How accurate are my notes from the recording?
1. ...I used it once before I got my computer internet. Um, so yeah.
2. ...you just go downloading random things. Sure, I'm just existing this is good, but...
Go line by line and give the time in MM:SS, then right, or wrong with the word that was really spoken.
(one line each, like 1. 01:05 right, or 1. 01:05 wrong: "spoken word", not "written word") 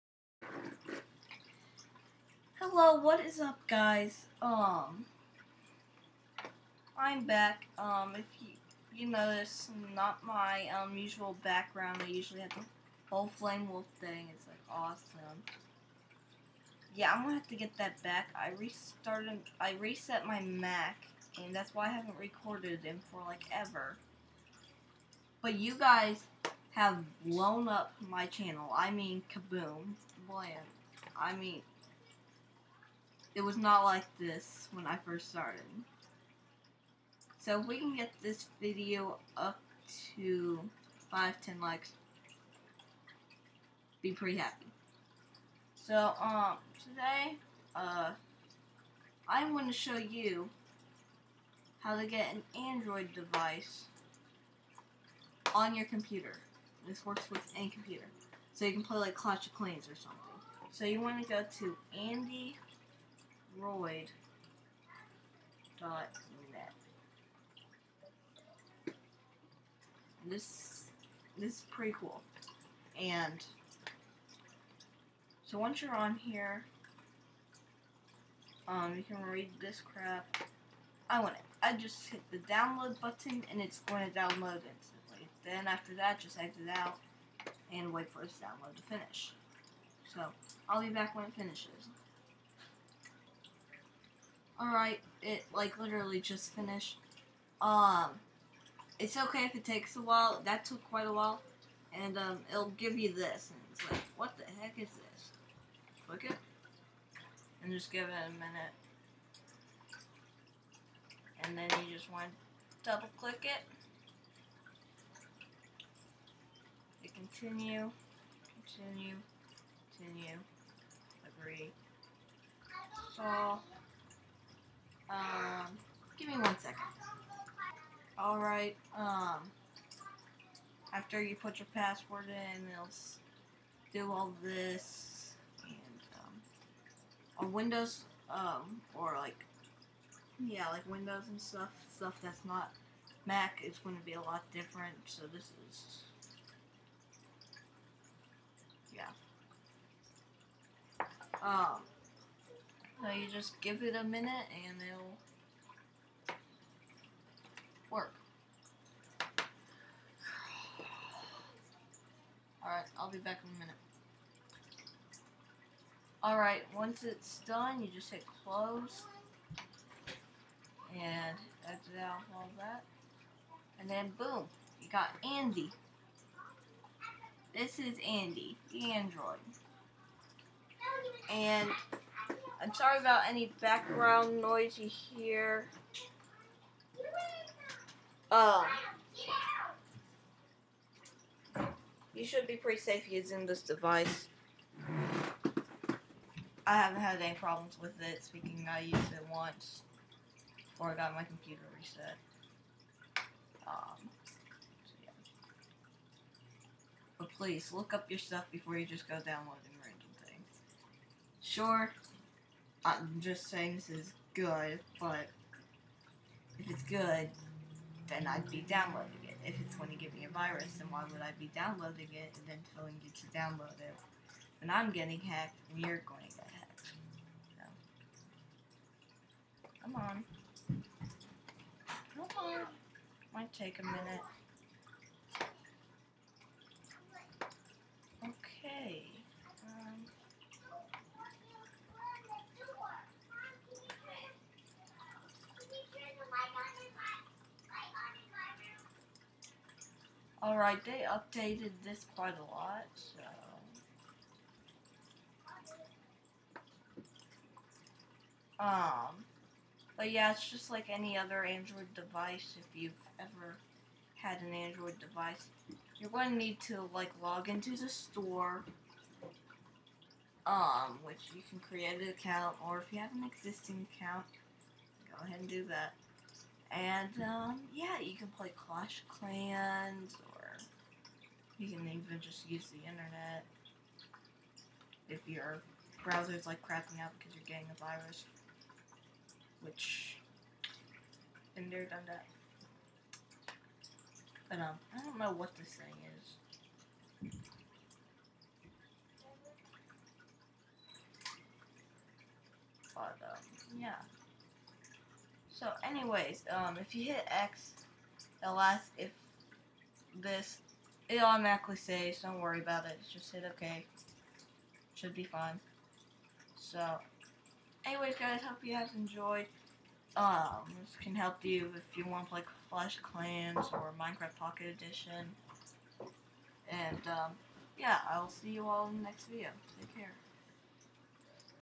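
1. 03:18 wrong: "reset", not "internet"
2. 03:28 wrong: "saying", not "existing".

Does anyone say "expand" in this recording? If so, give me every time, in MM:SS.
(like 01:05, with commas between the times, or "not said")
not said.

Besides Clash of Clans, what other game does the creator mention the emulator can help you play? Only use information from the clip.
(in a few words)
Minecraft Pocket Edition.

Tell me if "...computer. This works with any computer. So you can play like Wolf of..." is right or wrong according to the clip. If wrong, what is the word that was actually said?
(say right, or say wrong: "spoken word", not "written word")
wrong: "Clash", not "Wolf".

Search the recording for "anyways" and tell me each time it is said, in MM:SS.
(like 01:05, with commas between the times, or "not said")
05:05, 05:17.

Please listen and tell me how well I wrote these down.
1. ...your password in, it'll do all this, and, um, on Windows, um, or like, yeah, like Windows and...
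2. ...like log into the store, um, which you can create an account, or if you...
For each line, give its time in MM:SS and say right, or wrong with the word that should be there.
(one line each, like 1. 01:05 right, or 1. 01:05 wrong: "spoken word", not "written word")
1. 02:11 right
2. 04:26 right.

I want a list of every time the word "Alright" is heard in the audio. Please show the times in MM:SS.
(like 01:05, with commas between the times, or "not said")
01:34, 02:08, 02:46, 04:10.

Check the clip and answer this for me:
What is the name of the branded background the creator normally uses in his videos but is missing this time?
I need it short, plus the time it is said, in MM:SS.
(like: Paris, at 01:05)
Flame Wolf, at 00:13.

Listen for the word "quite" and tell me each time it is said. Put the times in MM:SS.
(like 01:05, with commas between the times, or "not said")
01:40, 04:12.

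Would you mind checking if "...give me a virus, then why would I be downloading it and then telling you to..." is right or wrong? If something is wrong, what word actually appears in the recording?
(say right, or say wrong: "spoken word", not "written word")
right.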